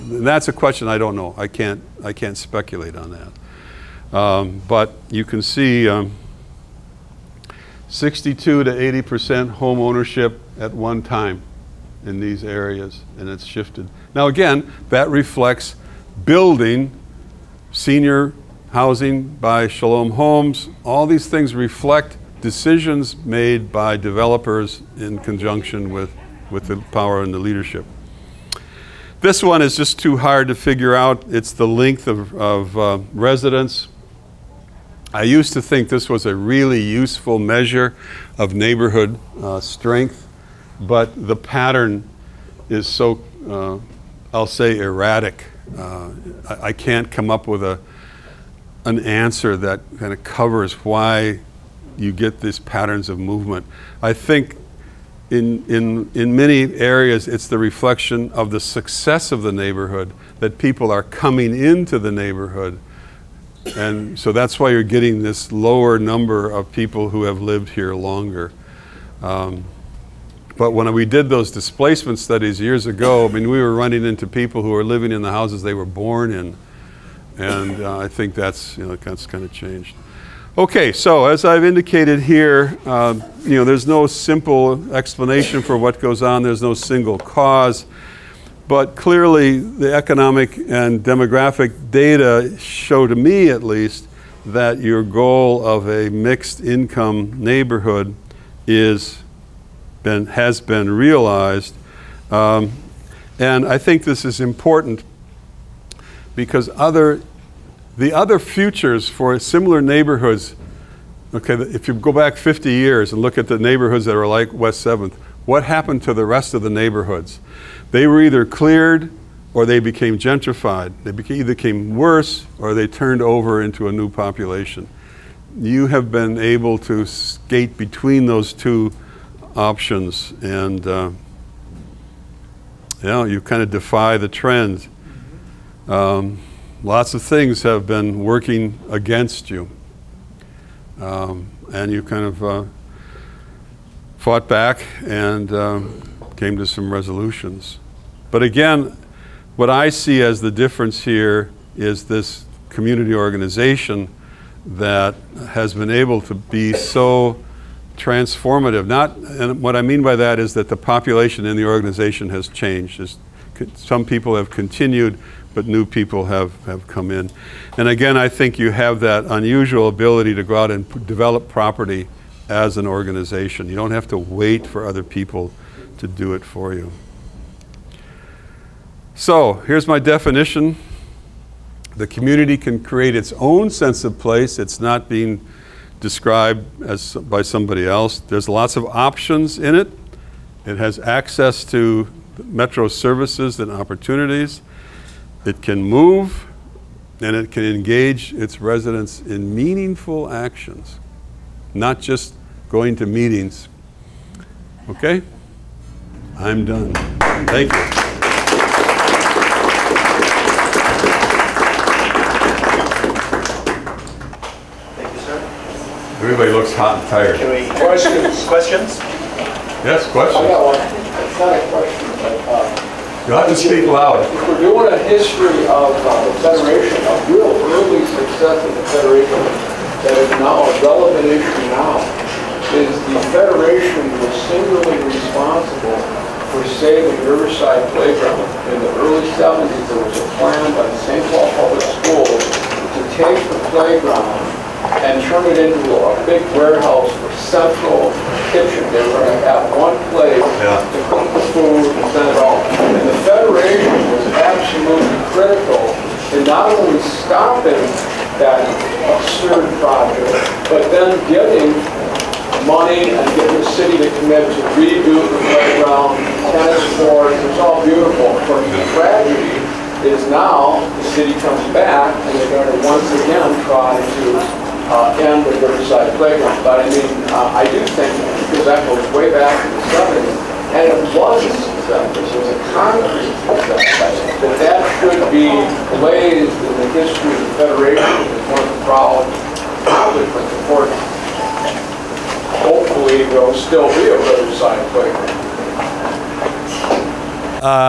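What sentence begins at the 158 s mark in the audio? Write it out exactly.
Not, and what I mean by that is that the population in the organization has changed.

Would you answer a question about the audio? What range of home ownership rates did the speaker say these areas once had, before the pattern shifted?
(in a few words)
62 to 80 percent.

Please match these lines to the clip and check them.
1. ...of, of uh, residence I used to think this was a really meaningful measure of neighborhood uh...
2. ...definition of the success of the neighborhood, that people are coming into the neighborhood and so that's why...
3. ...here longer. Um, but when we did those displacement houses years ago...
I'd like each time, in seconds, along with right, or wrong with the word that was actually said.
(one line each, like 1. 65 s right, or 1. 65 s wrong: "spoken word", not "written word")
1. 32 s wrong: "useful", not "meaningful"
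2. 57 s wrong: "reflection", not "definition"
3. 67 s wrong: "studies", not "houses".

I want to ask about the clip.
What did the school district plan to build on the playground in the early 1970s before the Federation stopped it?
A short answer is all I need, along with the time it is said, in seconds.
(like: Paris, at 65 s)
Central kitchen, at 247 s.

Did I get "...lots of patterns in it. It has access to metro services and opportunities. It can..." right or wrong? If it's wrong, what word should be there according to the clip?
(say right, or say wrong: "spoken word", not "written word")
wrong: "options", not "patterns".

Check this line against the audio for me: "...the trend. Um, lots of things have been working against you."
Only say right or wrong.
right.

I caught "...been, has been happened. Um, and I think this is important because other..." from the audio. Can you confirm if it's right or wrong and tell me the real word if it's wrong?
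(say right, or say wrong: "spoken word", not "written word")
wrong: "realized", not "happened".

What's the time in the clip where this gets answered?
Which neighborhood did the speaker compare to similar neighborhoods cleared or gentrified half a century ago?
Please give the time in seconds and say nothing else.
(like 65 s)
114 s.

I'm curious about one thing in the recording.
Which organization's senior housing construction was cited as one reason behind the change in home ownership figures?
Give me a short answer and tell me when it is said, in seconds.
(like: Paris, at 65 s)
Shalom Homes, at 19 s.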